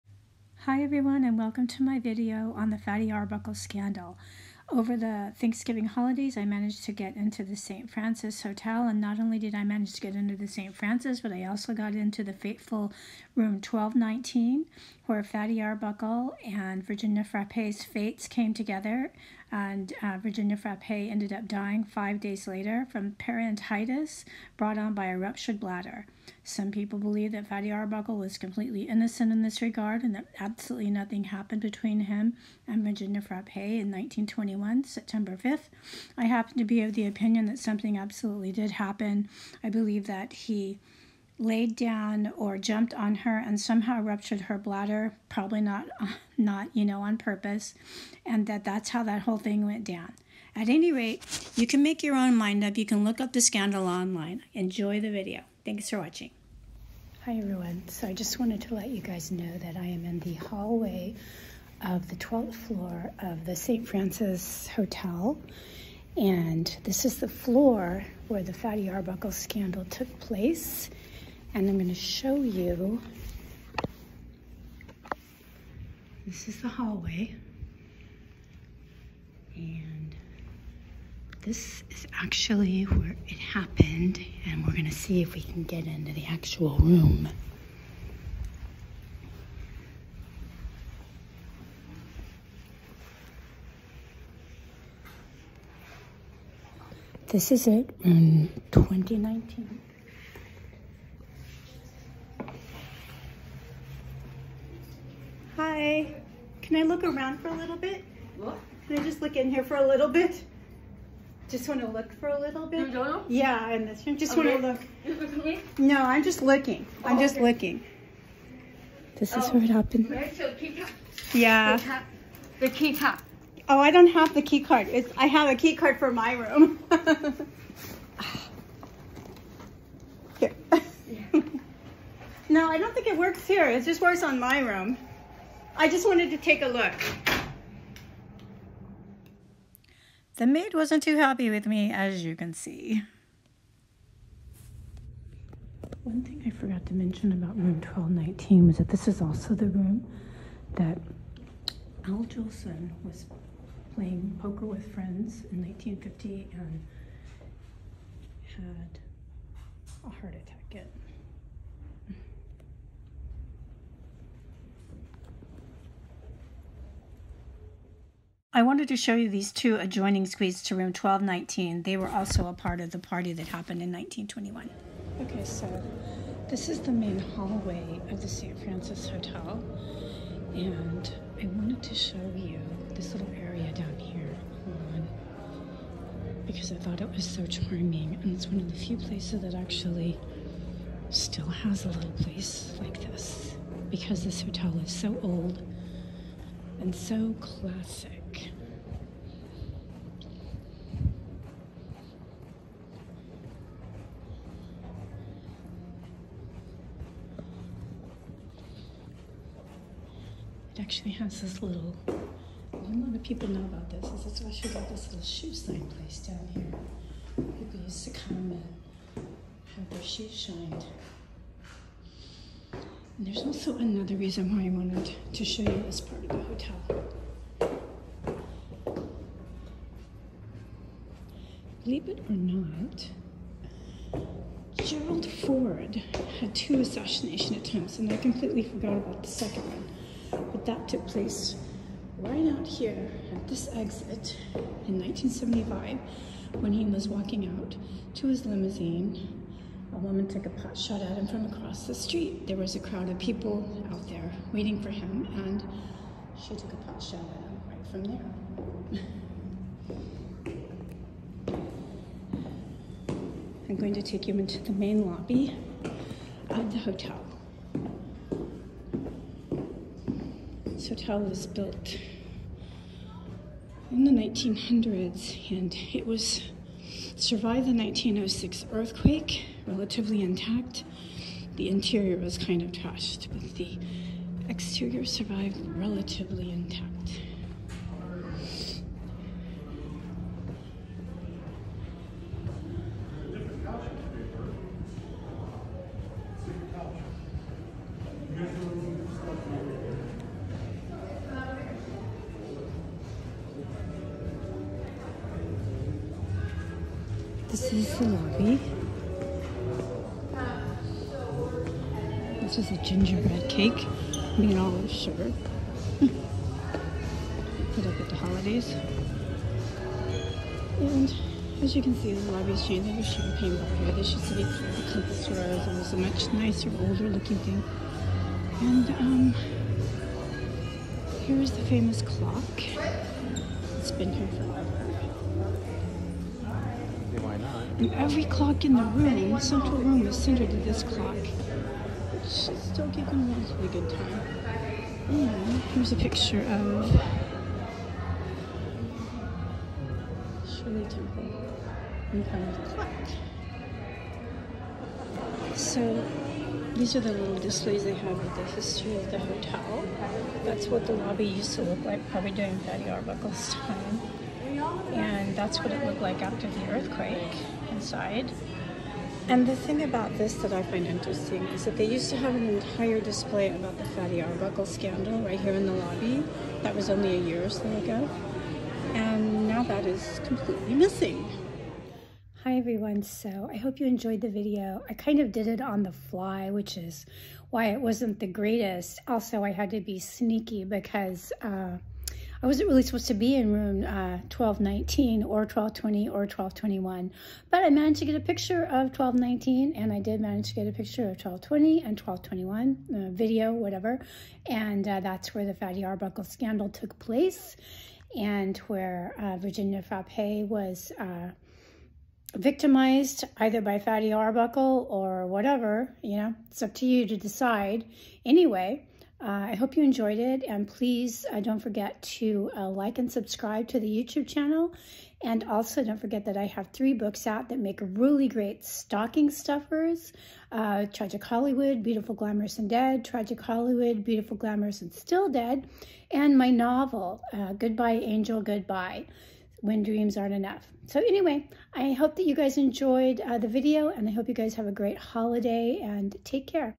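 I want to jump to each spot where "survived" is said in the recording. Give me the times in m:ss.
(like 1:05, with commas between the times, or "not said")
4:37, 4:45.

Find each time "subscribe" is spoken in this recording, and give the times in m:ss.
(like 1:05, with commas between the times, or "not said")
7:03.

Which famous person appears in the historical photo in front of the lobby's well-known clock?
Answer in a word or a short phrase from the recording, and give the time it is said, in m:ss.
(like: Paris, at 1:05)
Shirley Temple, at 5:50.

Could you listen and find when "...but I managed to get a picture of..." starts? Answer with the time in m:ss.
6:37.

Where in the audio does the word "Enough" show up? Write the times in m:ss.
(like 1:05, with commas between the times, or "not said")
7:20.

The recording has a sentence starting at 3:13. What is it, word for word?
Because this hotel is so old and so classic.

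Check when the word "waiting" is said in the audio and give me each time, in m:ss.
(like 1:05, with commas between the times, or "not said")
4:14.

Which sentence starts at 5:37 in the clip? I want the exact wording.
And every clock in the room, the central room, is centered to this clock.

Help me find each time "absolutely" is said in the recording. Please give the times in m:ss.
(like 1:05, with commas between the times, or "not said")
0:30, 0:37.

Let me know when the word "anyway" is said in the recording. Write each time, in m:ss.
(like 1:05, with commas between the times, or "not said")
6:58, 7:20.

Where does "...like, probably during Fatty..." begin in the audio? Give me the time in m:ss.
6:01.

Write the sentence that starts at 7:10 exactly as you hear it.
Uh, Tragic Hollywood, Beautiful, Glamorous, and Dead.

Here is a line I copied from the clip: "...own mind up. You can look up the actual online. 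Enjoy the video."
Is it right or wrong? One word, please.
wrong.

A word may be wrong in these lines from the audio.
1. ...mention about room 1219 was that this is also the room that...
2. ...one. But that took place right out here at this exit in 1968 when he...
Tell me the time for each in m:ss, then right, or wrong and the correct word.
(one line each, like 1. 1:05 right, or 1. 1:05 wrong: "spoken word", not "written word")
1. 2:26 right
2. 3:59 wrong: "1975", not "1968".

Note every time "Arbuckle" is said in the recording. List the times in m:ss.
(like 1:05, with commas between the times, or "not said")
0:03, 0:15, 0:27, 1:08, 6:02, 6:14, 6:45, 6:54.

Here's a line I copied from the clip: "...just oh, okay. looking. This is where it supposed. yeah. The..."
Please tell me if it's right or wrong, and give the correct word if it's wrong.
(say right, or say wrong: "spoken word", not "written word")
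wrong: "happened", not "supposed".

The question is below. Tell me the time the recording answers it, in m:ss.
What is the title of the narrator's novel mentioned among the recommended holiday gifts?
7:17.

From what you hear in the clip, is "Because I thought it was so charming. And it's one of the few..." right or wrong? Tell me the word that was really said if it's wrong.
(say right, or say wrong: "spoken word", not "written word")
right.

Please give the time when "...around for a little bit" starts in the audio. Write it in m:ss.
1:47.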